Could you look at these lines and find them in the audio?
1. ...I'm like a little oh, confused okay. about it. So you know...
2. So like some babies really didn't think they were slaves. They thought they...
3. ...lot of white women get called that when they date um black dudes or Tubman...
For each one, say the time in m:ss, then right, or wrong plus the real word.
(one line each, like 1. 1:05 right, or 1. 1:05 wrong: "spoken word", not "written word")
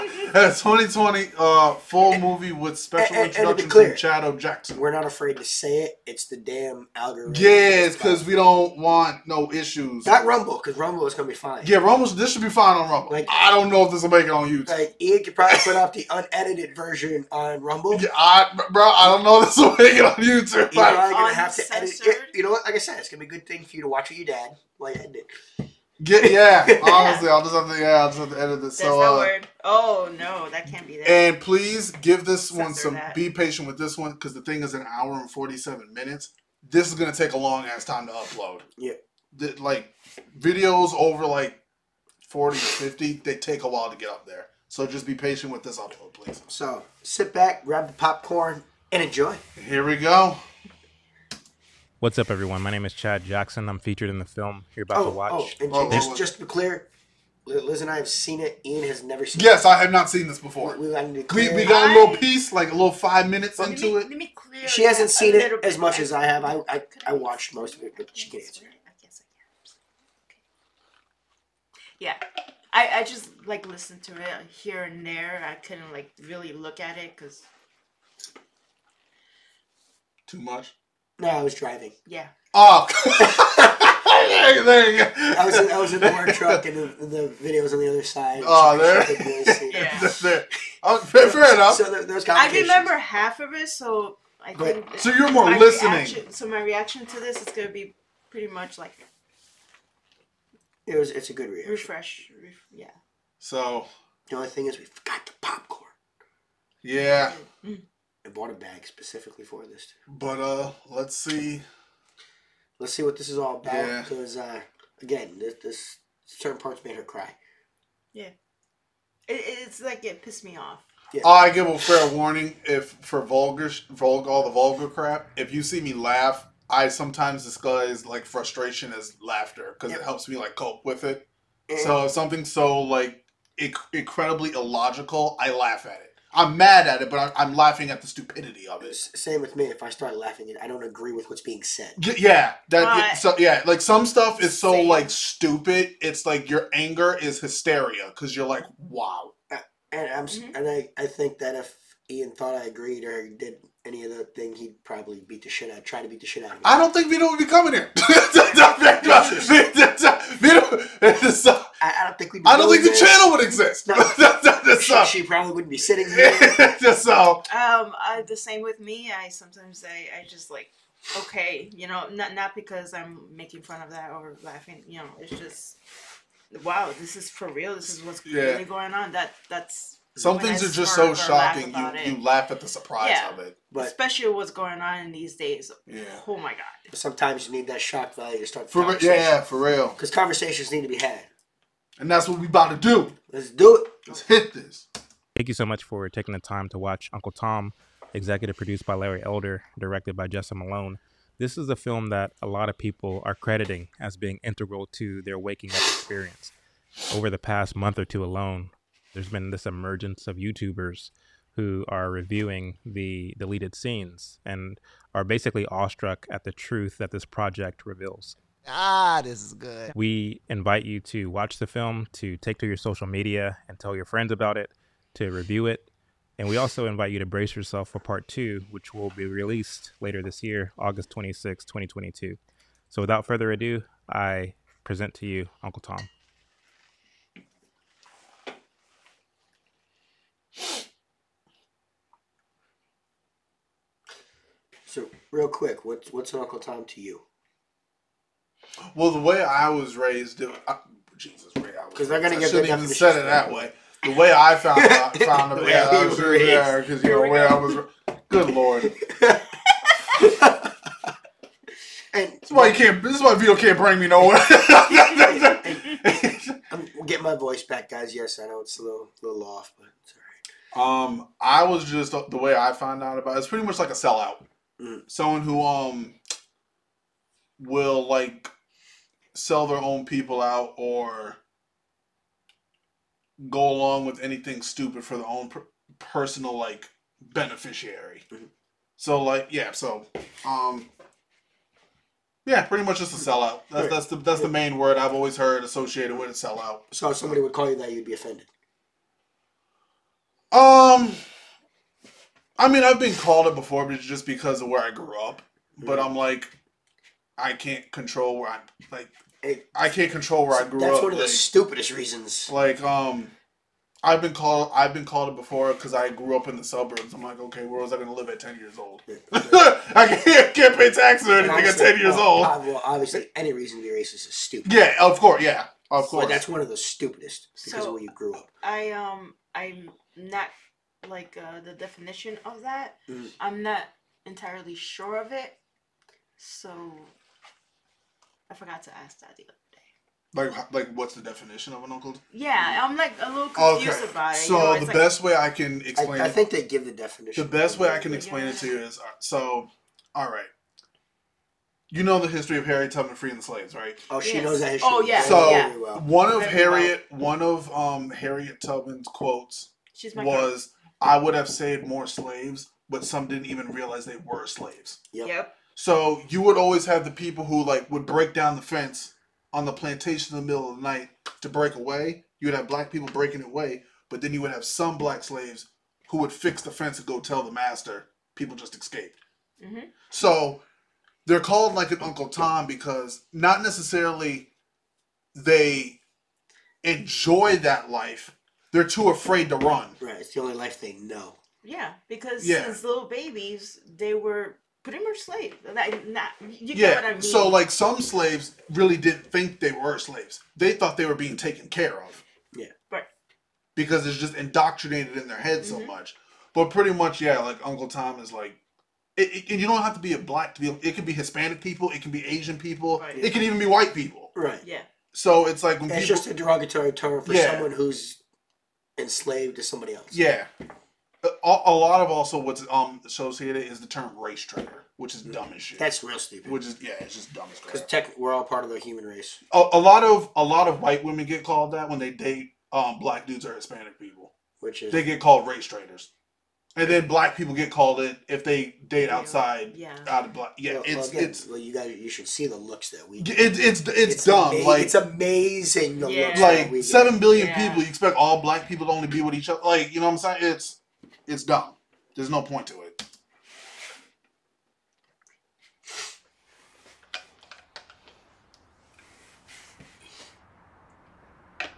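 1. 5:42 right
2. 6:37 wrong: "slaves", not "babies"
3. 7:10 wrong: "Hispanic", not "Tubman".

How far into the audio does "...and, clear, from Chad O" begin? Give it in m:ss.
0:03.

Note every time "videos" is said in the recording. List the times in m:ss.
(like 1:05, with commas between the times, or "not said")
0:40, 1:27.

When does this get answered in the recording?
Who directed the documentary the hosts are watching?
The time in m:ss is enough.
3:20.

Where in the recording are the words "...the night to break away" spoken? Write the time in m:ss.
6:10.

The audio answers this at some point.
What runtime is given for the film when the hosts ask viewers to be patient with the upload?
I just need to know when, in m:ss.
0:34.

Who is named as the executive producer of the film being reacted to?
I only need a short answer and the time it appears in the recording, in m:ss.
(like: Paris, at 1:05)
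Larry Elder, at 3:18.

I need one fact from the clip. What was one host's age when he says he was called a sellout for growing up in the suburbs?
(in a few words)
10.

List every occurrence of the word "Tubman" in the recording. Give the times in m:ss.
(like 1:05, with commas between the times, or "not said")
5:52, 5:58.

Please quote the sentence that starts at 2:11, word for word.
So if something so like inc- incredibly illogical, I laugh at it.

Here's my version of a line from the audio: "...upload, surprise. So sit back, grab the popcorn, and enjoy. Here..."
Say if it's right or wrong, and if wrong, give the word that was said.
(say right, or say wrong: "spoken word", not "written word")
wrong: "please", not "surprise".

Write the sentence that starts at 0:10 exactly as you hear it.
Not Rumble, because Rumble is gonna be fine.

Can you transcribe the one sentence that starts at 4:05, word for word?
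real quick, what's what's an Uncle Tom to you?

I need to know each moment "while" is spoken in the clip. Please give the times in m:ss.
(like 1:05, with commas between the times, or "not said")
0:24, 0:43.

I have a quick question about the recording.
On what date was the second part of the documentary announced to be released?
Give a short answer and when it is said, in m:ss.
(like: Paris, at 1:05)
August 26, 2022, at 3:50.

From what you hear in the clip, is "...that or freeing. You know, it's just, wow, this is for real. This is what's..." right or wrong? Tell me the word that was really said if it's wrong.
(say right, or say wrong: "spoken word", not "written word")
wrong: "laughing", not "freeing".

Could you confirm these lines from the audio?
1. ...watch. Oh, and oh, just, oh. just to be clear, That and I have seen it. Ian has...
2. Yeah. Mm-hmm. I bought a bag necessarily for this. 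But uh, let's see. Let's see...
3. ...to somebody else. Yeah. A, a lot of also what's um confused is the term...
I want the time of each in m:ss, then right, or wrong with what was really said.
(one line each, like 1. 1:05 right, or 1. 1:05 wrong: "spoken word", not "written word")
1. 0:55 wrong: "Liz", not "That"
2. 1:46 wrong: "specifically", not "necessarily"
3. 6:59 wrong: "associated", not "confused".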